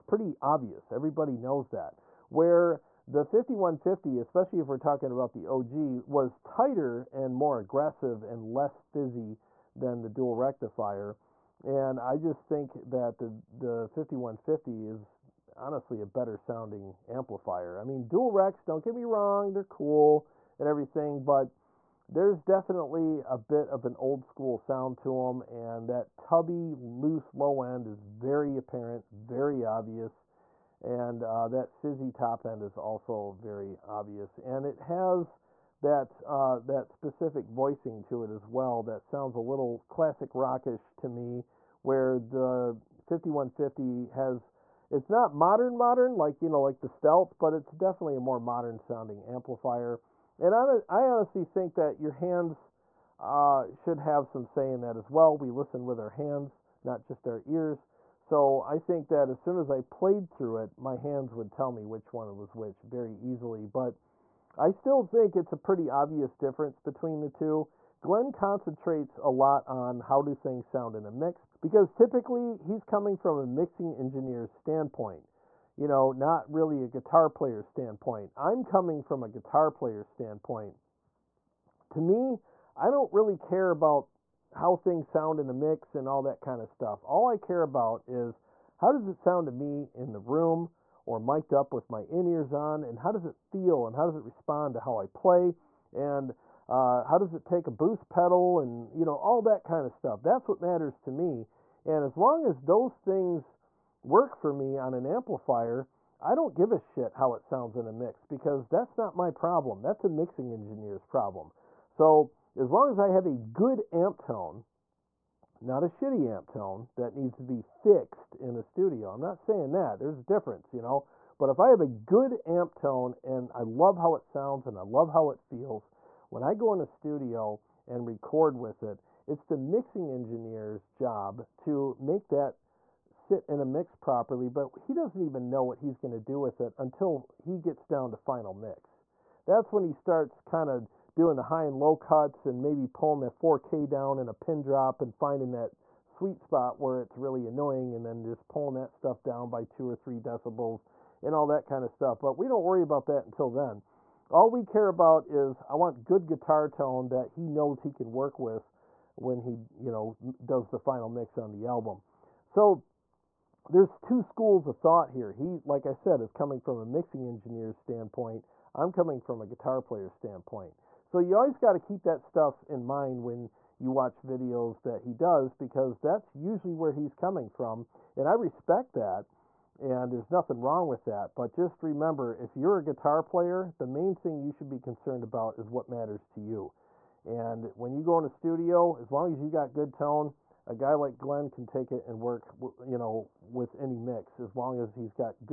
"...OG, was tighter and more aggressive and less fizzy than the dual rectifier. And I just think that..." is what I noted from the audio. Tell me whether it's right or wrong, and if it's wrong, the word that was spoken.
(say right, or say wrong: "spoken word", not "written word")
right.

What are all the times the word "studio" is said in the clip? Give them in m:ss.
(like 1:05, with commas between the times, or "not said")
1:58, 2:06, 3:08.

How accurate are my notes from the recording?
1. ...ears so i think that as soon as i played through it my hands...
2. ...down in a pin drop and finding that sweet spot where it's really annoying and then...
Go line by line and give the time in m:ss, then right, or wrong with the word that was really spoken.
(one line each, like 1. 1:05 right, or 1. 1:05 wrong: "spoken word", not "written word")
1. 0:57 right
2. 2:23 right.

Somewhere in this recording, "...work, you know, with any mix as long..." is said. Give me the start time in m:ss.
3:12.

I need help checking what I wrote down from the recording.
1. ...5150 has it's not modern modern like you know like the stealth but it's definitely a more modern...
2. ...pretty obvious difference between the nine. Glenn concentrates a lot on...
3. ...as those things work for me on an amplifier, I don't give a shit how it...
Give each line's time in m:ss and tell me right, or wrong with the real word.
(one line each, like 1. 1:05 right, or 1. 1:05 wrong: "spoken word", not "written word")
1. 0:43 right
2. 1:05 wrong: "two", not "nine"
3. 1:42 right.